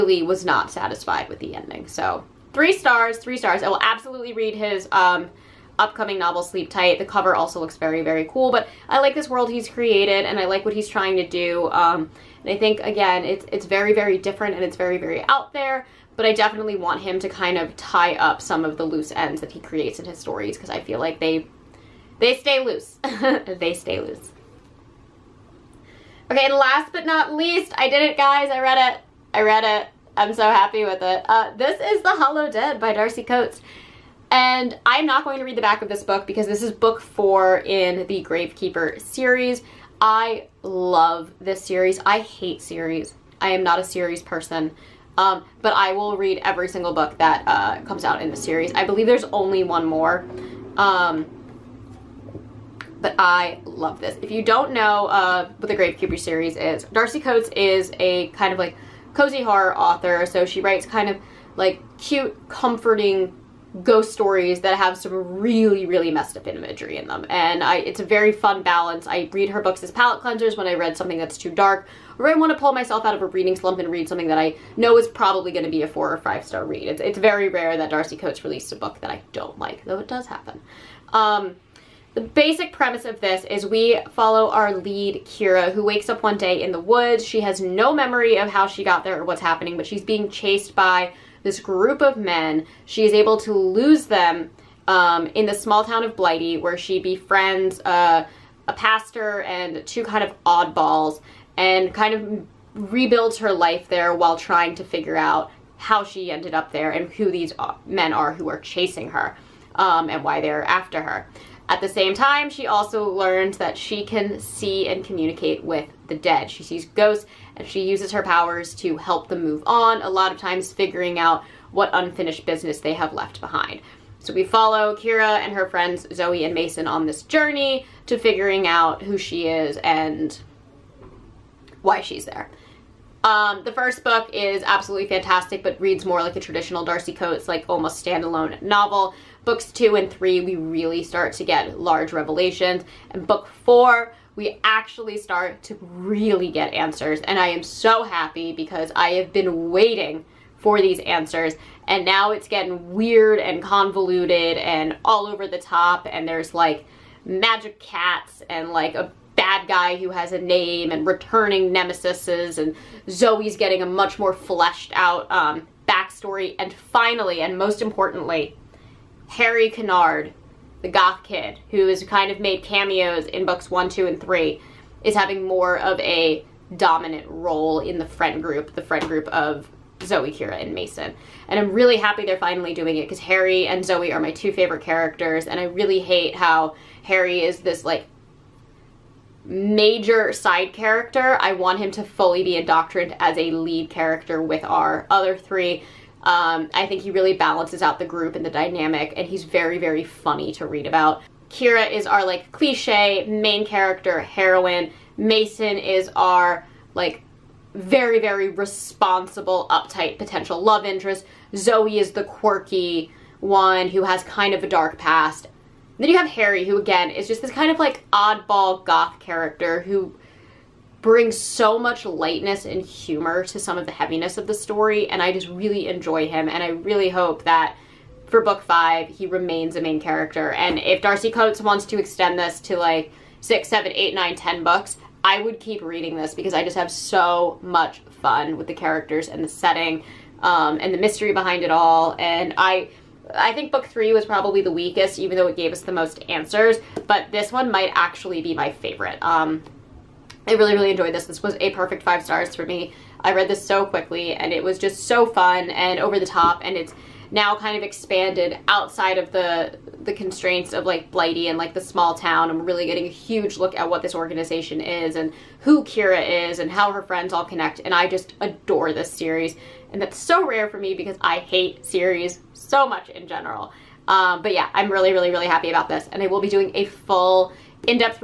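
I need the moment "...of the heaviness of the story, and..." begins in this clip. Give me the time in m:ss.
3:43.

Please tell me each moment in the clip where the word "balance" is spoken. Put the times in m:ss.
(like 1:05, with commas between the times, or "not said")
1:08, 3:17.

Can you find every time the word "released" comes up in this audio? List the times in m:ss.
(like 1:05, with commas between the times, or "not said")
1:18.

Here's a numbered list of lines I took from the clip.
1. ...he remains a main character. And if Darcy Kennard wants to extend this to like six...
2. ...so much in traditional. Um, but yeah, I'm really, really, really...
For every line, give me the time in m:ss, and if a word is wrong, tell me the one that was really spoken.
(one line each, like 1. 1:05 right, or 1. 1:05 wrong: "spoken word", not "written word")
1. 3:49 wrong: "Coates", not "Kennard"
2. 4:32 wrong: "general", not "traditional".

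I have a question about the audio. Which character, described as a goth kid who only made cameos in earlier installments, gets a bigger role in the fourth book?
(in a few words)
Harry Kennard.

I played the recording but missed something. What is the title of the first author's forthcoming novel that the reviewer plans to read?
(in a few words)
Sleep Tight.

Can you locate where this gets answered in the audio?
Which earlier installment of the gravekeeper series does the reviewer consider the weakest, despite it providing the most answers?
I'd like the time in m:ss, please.
4:03.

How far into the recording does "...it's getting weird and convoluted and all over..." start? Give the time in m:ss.
2:32.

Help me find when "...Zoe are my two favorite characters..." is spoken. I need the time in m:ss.
3:03.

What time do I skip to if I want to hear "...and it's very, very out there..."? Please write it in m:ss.
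0:14.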